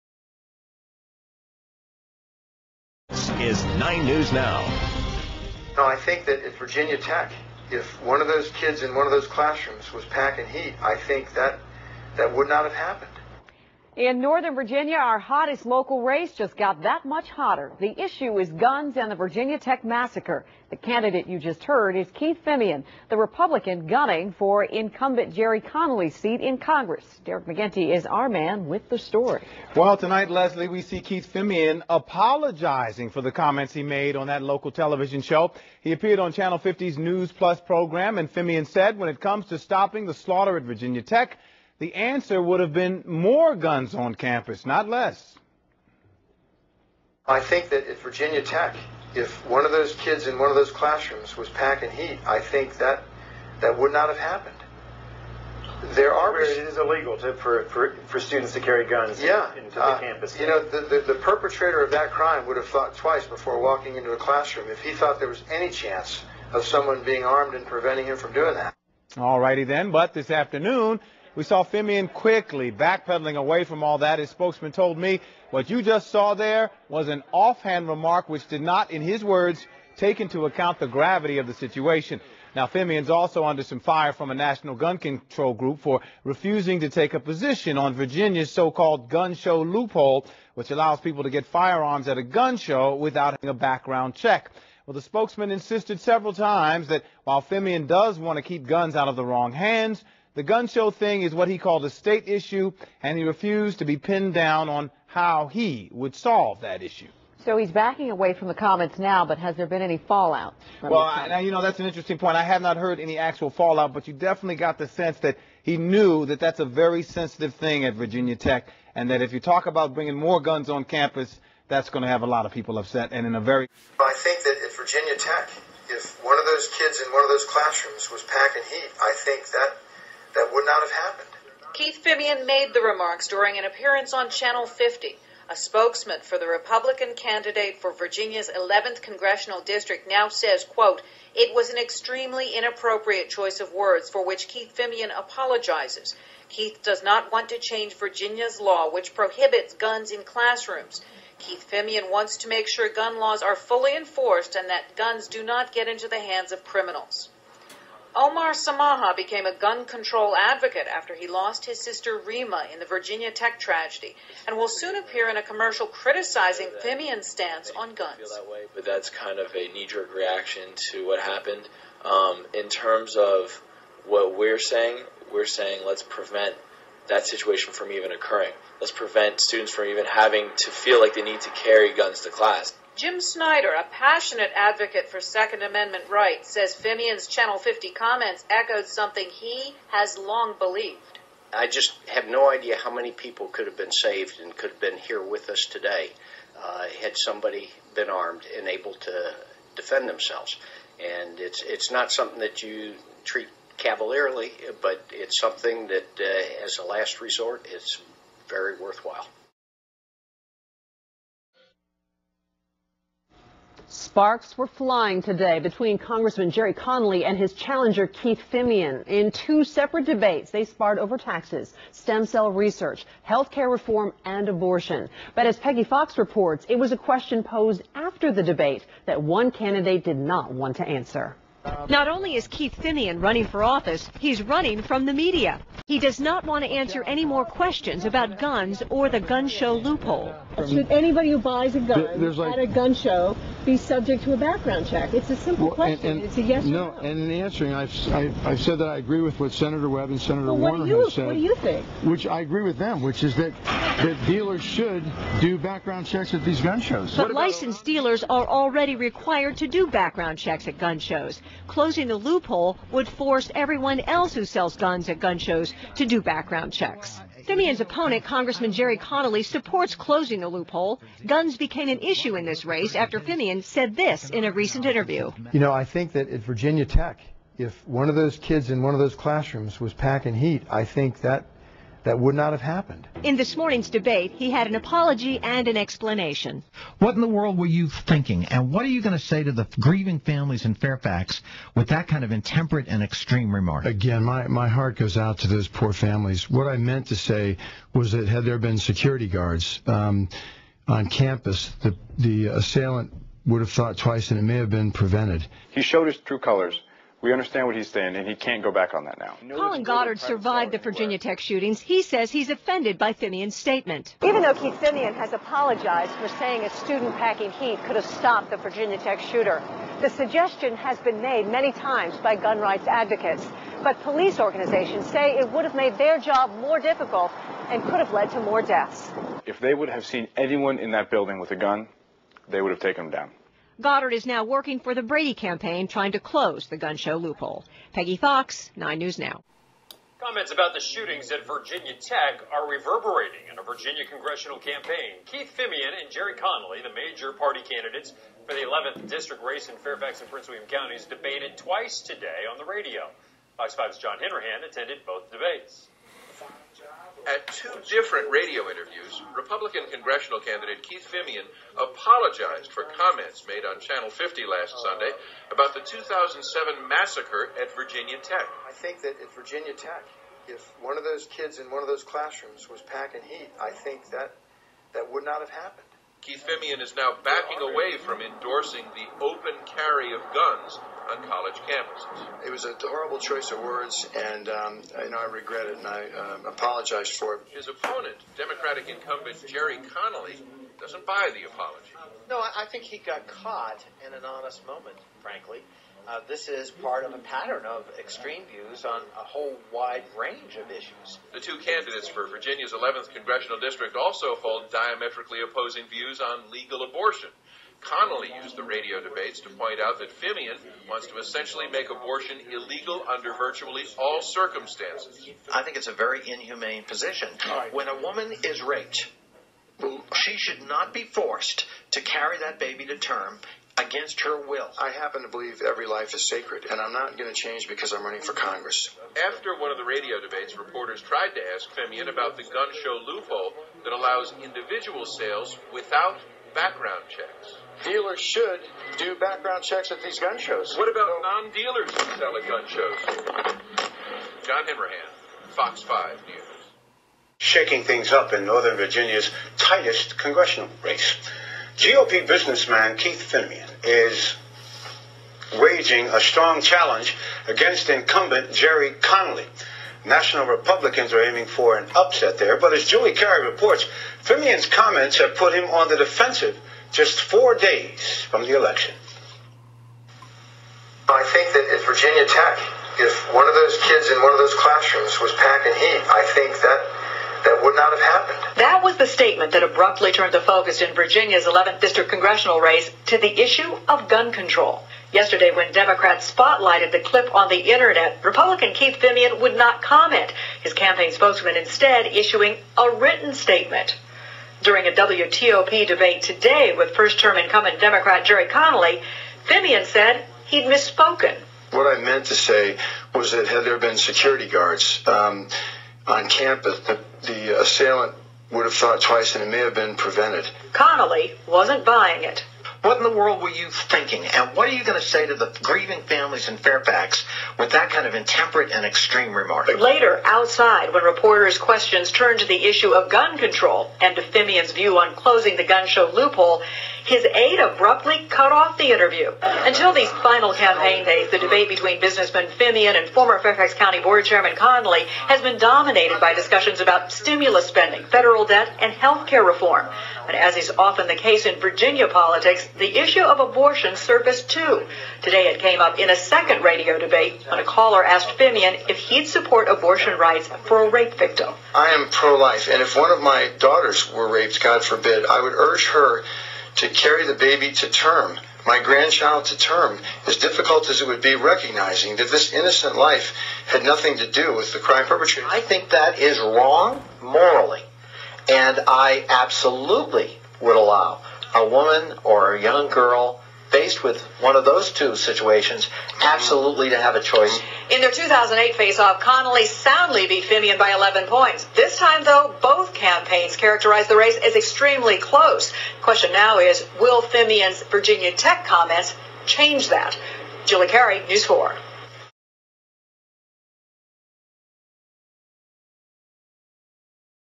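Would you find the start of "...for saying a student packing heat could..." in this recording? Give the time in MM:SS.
05:16.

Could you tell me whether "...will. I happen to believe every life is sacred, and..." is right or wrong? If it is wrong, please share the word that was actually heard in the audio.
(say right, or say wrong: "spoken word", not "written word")
right.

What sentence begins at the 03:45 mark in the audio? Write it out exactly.
But as Peggy Fox reports, it was a question posed after the debate that one candidate did not want to answer.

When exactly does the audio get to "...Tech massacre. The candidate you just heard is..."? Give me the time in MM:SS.
00:19.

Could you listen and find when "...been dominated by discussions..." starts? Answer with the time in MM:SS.
08:55.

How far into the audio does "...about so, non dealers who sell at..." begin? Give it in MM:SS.
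07:20.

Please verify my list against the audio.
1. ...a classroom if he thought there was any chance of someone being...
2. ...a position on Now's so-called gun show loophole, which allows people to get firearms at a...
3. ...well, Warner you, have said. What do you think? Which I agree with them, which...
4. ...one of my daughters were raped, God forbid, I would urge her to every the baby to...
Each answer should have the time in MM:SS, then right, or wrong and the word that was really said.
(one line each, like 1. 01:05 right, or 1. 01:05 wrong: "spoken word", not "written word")
1. 01:04 right
2. 01:27 wrong: "Virginia", not "Now"
3. 04:10 right
4. 09:12 wrong: "carry", not "every".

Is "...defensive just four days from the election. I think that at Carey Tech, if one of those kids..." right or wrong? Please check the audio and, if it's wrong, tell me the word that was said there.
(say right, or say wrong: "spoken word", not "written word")
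wrong: "Virginia", not "Carey".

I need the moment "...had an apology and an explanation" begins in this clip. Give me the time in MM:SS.
04:44.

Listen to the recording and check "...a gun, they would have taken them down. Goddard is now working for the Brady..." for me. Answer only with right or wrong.
right.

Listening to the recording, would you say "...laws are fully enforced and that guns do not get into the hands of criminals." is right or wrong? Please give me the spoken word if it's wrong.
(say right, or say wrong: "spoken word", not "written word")
right.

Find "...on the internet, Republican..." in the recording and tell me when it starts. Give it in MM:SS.
08:07.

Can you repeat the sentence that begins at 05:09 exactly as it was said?
Colin Goddard survived the Virginia Tech shootings.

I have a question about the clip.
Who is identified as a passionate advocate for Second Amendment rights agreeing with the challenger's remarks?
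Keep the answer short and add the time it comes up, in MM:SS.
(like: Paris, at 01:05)
Jim Snyder, at 03:02.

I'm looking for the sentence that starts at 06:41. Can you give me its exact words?
The two candidates for Virginia's 11th congressional district also hold diametrically opposing views on legal abortion.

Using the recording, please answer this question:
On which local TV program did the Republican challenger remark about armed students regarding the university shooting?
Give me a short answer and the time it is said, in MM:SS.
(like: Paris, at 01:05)
Channel 50's News Plus, at 00:36.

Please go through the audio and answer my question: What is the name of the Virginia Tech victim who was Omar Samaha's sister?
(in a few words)
Rima.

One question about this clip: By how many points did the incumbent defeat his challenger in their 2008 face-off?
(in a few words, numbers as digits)
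11.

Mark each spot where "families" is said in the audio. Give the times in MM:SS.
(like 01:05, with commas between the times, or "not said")
04:50, 04:55, 08:36.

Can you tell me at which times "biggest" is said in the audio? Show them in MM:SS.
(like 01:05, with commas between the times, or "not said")
not said.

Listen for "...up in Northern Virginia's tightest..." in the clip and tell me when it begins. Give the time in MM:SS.
07:28.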